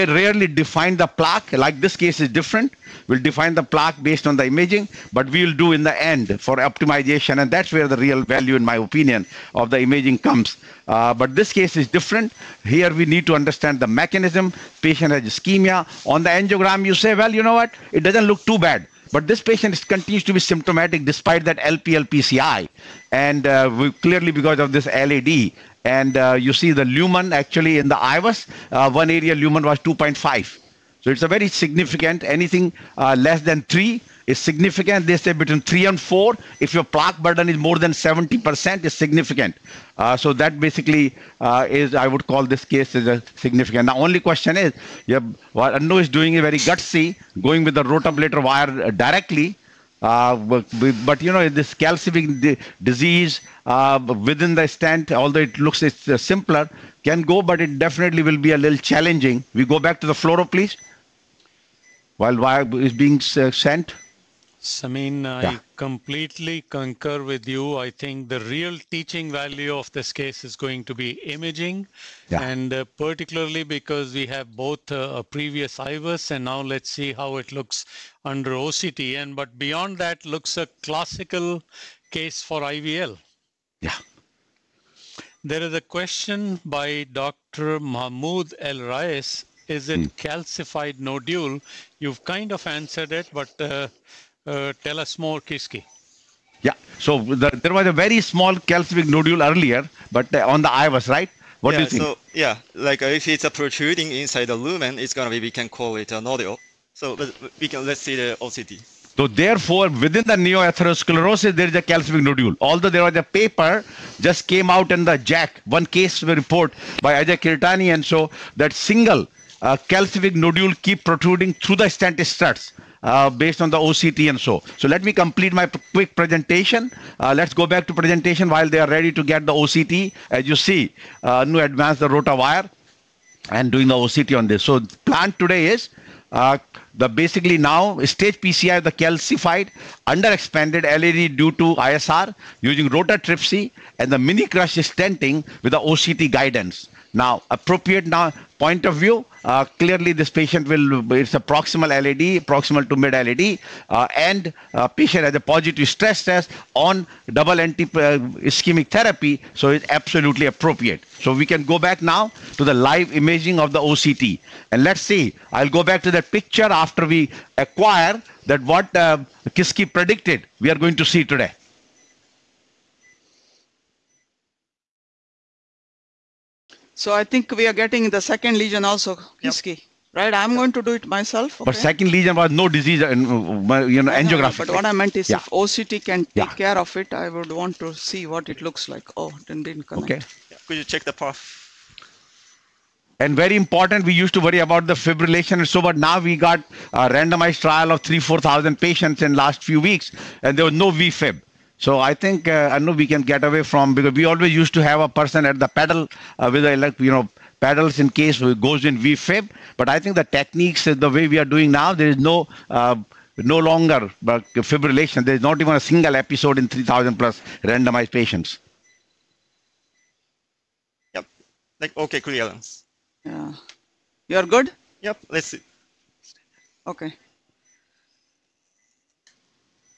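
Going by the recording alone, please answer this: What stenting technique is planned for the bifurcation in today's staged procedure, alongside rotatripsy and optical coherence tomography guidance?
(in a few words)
mini crush.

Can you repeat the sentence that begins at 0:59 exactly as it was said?
We go back to the fluoro, please.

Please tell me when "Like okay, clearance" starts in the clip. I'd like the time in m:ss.
3:41.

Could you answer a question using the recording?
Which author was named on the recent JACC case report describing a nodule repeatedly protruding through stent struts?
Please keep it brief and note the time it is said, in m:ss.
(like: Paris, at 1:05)
Ajay Kirtane, at 1:57.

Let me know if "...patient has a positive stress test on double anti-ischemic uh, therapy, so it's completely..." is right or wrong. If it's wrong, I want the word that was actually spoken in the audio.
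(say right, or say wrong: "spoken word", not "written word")
wrong: "absolutely", not "completely".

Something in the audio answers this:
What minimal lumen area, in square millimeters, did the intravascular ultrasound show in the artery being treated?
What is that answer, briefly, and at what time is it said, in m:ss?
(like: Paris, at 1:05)
2.5, at 0:29.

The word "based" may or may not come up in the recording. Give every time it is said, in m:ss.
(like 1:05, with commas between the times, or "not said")
0:04, 2:03.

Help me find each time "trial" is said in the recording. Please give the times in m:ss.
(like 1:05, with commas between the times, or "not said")
3:17.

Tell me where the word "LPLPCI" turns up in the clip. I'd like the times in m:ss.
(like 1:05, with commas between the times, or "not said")
0:21.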